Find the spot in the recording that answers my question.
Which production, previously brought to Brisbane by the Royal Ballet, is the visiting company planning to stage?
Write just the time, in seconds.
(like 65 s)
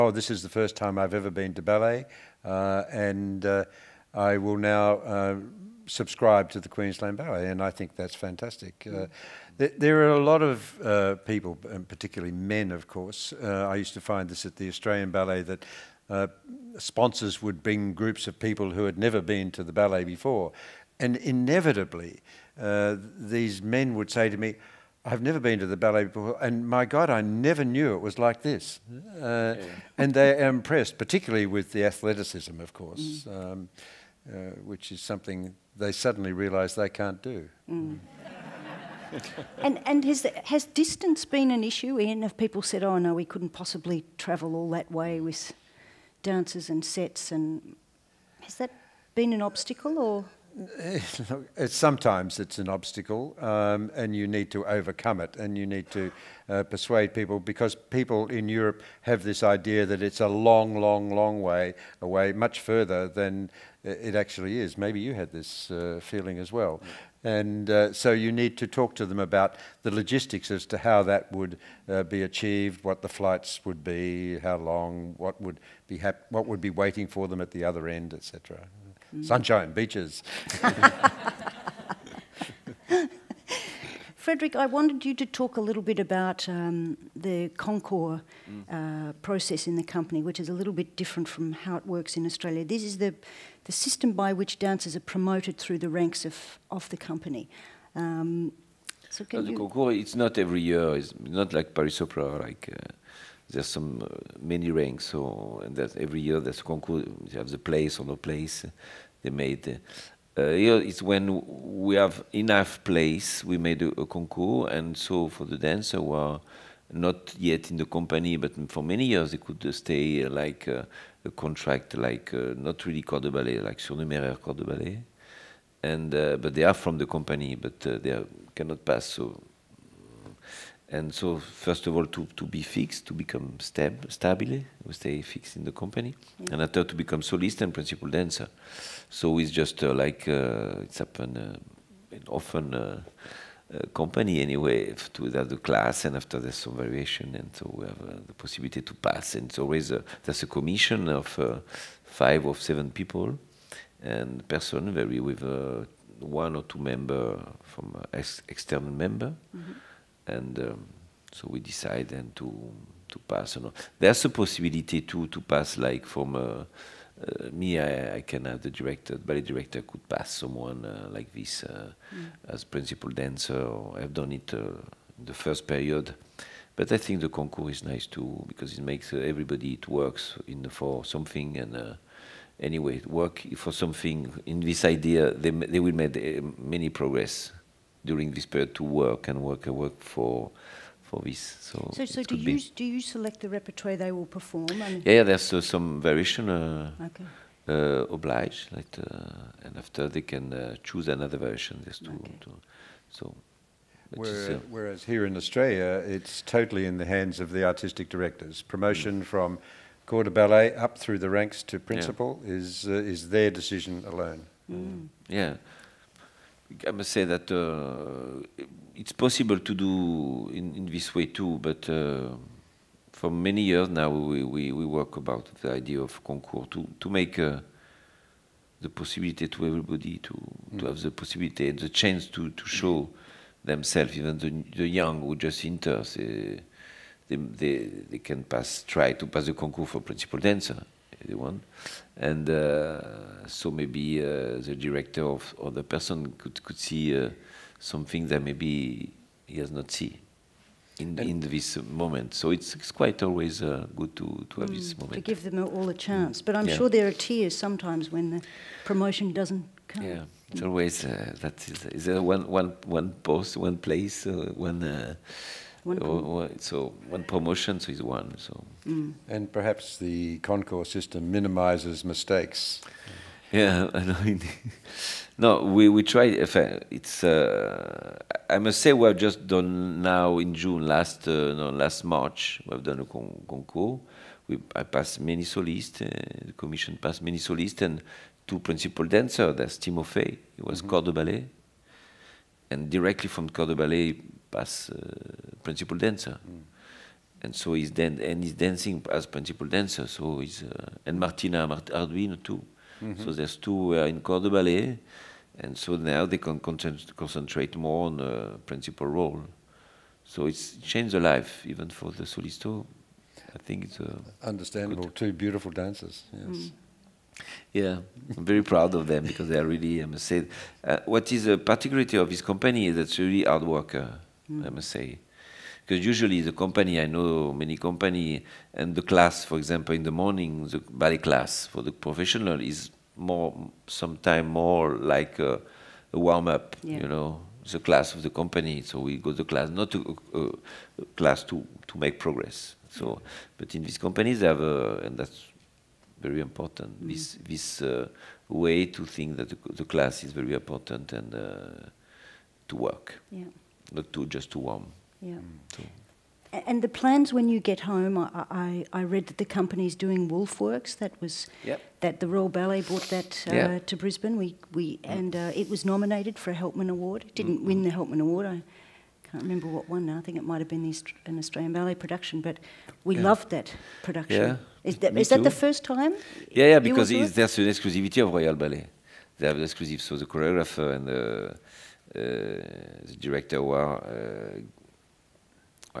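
360 s.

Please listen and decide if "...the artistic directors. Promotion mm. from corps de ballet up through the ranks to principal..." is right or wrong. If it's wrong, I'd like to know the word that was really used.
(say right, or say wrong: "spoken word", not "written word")
right.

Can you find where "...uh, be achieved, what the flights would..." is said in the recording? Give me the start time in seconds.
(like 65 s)
71 s.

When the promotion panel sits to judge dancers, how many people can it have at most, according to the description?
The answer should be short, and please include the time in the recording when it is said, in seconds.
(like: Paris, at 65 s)
7, at 152 s.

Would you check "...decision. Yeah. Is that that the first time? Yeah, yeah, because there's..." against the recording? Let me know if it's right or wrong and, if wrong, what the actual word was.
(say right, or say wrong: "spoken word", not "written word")
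wrong: "production", not "decision".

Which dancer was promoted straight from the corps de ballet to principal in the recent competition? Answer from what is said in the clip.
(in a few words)
Timofey.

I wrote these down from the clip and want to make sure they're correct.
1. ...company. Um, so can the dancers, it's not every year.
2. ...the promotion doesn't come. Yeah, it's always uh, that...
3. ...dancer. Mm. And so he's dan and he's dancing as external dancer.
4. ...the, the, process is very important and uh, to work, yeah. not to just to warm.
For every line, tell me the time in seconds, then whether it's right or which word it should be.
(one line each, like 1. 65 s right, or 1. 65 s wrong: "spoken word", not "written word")
1. 96 s wrong: "concours", not "dancers"
2. 258 s right
3. 295 s wrong: "principal", not "external"
4. 349 s wrong: "class", not "process".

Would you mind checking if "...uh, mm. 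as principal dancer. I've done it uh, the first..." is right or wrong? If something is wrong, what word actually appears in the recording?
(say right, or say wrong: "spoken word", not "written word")
right.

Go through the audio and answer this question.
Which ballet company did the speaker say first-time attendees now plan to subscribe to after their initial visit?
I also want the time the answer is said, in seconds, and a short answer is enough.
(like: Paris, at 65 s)
Queensland Ballet, at 6 s.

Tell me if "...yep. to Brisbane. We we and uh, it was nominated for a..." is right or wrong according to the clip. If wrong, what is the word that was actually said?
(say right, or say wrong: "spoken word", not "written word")
right.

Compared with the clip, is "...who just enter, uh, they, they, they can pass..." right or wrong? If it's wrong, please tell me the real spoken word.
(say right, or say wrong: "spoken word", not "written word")
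right.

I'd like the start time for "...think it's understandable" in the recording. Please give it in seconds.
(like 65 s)
313 s.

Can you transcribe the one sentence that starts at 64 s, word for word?
Maybe you had this uh, feeling as well.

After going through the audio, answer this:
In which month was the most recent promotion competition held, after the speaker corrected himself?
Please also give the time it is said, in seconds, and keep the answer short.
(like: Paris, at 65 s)
March, at 282 s.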